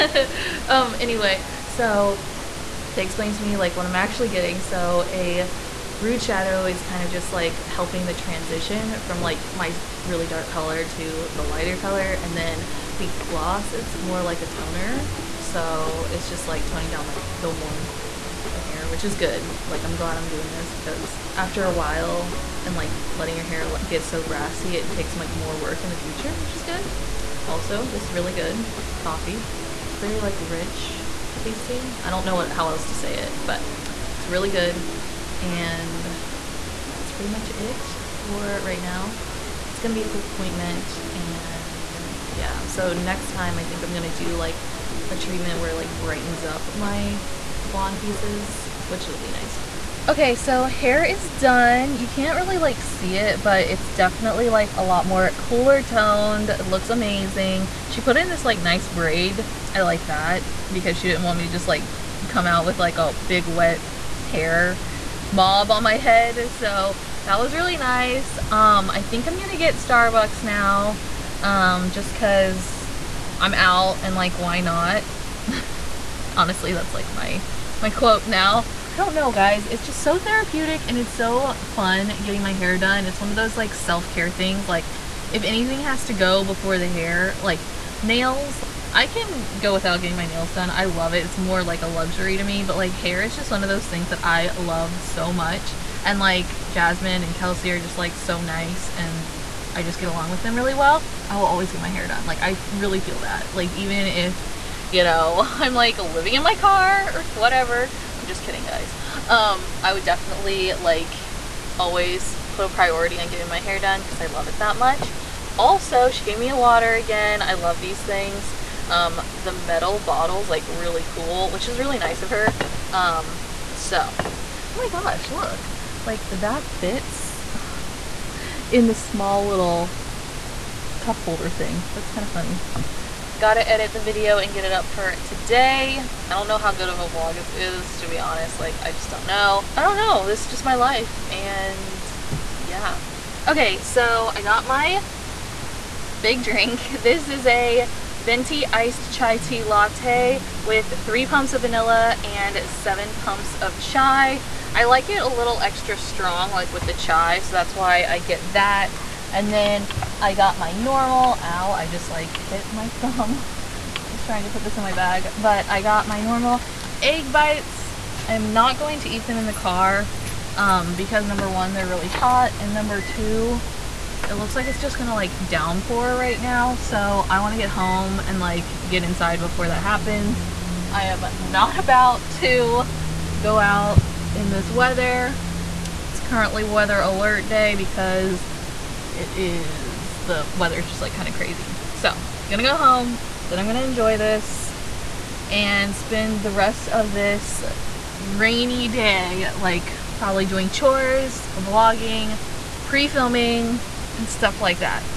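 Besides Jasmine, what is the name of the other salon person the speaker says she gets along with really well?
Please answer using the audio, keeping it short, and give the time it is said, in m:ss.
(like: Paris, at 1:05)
Kelsey, at 1:37.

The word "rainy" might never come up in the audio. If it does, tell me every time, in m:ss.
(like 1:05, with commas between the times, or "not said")
3:18.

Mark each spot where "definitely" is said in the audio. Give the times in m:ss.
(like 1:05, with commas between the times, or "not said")
0:53, 1:50.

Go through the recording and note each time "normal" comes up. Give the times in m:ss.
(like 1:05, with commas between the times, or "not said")
2:40, 2:46.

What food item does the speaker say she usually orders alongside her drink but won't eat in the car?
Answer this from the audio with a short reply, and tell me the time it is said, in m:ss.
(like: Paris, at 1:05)
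Egg bites, at 2:47.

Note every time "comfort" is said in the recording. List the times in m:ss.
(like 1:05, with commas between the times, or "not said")
not said.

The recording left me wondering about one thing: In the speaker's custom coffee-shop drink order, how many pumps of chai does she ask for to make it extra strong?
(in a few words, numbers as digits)
7.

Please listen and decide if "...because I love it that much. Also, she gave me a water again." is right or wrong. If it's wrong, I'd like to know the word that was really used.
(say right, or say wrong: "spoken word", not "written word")
right.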